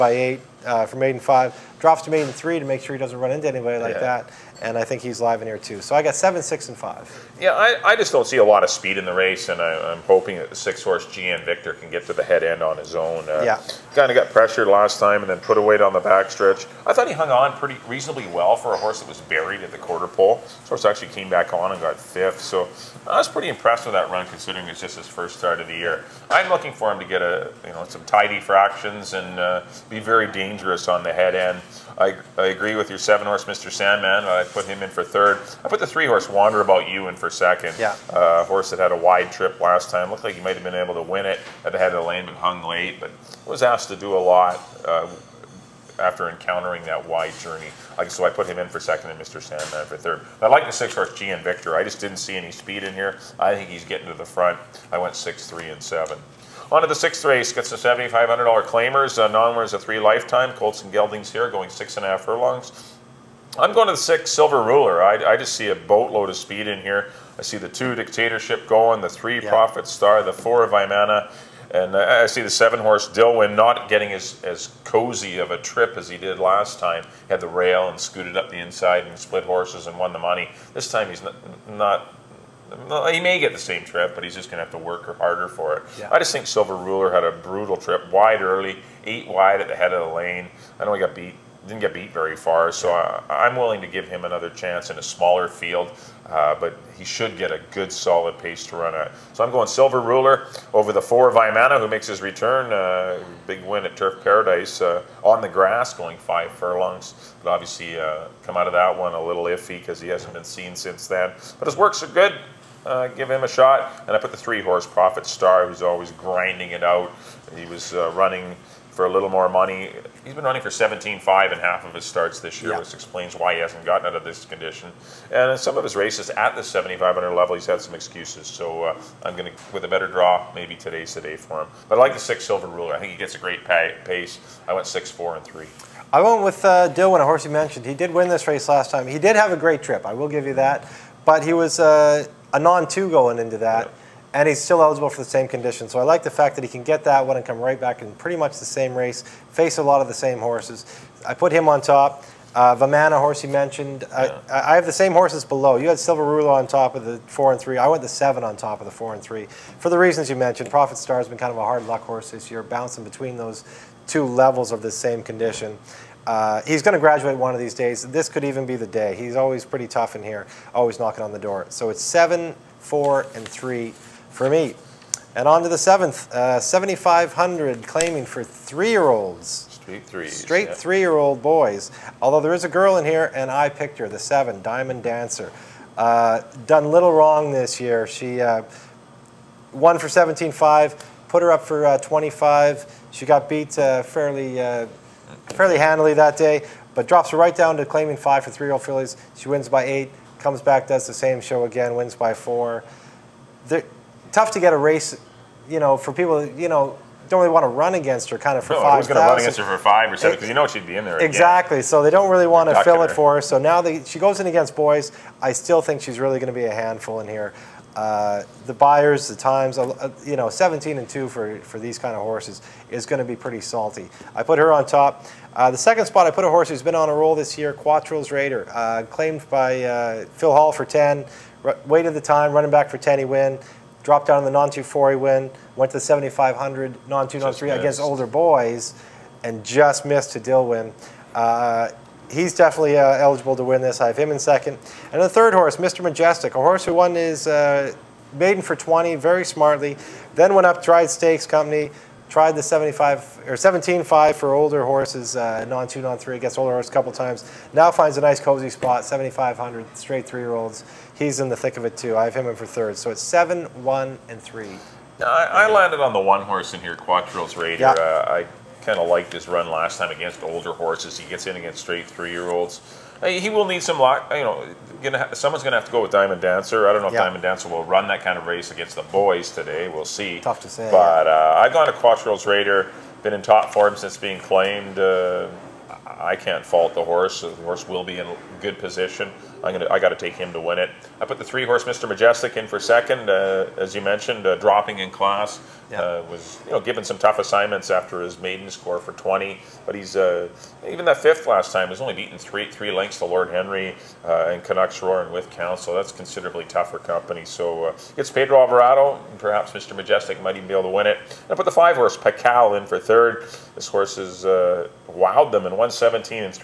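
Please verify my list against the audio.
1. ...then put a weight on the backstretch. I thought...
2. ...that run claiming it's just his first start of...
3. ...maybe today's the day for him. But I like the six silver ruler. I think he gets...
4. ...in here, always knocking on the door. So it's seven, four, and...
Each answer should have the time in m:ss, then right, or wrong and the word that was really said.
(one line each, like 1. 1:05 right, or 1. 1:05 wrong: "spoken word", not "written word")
1. 0:15 right
2. 0:23 wrong: "considering", not "claiming"
3. 2:10 right
4. 2:50 right.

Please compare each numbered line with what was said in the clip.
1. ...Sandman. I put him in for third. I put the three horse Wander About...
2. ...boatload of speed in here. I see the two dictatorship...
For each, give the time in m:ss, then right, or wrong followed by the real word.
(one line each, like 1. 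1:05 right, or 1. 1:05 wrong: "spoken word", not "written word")
1. 0:33 right
2. 1:05 right.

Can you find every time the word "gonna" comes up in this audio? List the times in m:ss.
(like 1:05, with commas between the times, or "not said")
4:35, 4:49.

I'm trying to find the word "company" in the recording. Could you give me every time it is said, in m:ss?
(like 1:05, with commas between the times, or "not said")
4:11, 5:06.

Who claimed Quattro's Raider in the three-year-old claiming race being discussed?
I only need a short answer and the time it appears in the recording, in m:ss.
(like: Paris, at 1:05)
Phil Hall, at 3:50.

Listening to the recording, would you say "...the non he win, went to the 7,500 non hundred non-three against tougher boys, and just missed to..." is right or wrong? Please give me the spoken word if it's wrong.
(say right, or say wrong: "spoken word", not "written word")
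wrong: "older", not "tougher".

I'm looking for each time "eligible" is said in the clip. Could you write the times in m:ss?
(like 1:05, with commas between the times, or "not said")
2:24, 4:03.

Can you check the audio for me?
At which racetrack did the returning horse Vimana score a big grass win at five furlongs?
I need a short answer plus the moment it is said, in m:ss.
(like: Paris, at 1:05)
Turf Paradise, at 1:43.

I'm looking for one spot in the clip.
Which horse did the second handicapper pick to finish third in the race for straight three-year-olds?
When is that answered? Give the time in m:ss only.
5:11.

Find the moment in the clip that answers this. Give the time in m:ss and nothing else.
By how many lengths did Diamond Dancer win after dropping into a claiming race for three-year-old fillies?
3:19.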